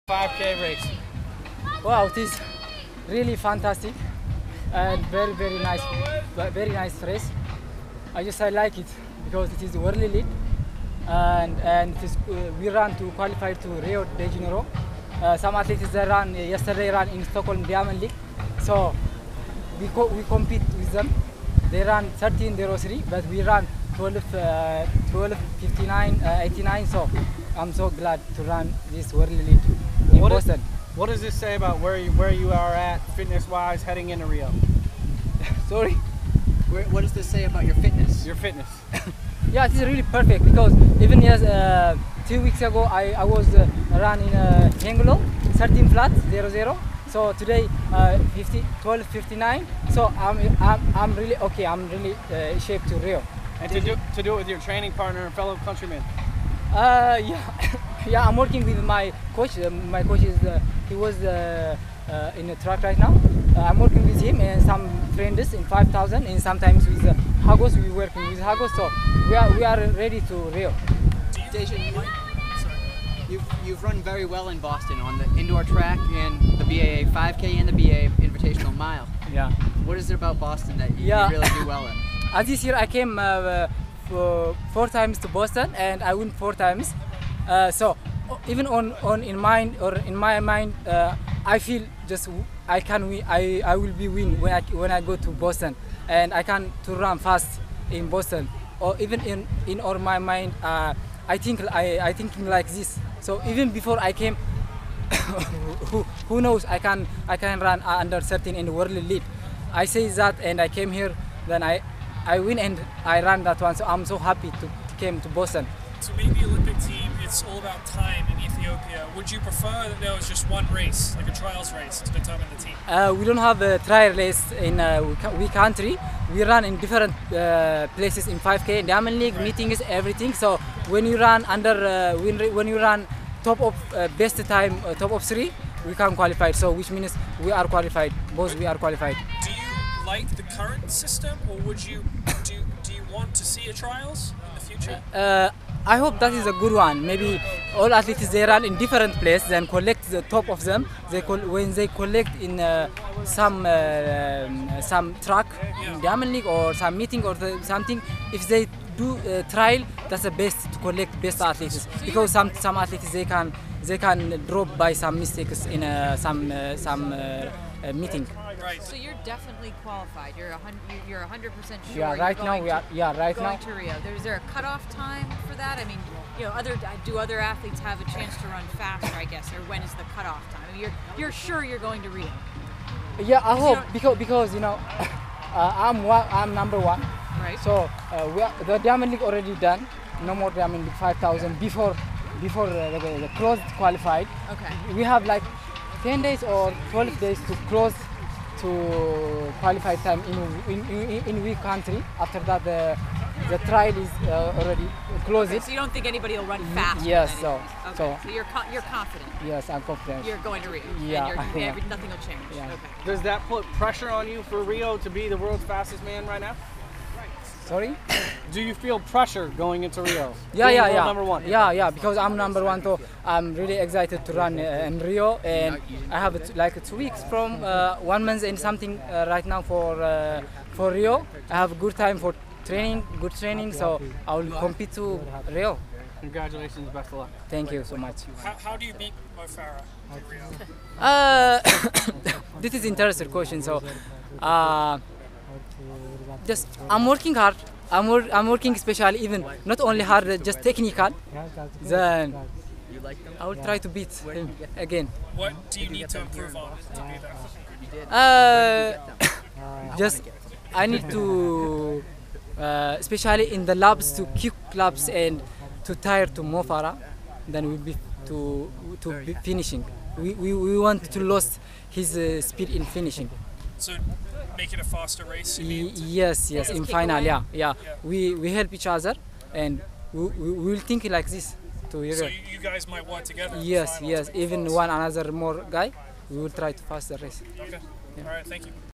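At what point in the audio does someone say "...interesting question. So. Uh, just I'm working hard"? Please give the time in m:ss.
4:02.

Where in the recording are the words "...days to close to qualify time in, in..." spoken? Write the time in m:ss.
3:17.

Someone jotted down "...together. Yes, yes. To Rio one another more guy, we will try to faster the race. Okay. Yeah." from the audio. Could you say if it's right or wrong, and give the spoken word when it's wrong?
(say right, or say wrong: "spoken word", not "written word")
wrong: "Even", not "Rio".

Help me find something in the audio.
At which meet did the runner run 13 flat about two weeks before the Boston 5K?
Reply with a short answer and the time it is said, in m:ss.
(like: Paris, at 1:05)
Hengelo, at 0:44.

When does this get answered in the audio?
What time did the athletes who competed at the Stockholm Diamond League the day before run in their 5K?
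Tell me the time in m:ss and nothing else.
0:22.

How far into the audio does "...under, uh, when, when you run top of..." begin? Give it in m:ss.
2:11.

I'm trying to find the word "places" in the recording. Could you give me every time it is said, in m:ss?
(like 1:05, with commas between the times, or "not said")
2:07, 2:29.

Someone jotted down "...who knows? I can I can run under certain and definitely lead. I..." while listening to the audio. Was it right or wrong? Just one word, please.
wrong.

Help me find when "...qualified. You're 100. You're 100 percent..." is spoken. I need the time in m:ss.
2:49.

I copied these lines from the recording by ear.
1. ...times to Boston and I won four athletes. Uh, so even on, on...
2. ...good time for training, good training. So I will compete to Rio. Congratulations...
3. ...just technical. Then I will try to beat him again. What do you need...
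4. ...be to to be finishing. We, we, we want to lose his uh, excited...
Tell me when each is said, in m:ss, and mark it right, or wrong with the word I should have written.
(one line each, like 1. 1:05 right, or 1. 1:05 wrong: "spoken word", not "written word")
1. 1:24 wrong: "times", not "athletes"
2. 3:51 right
3. 4:10 right
4. 4:27 wrong: "speed", not "excited".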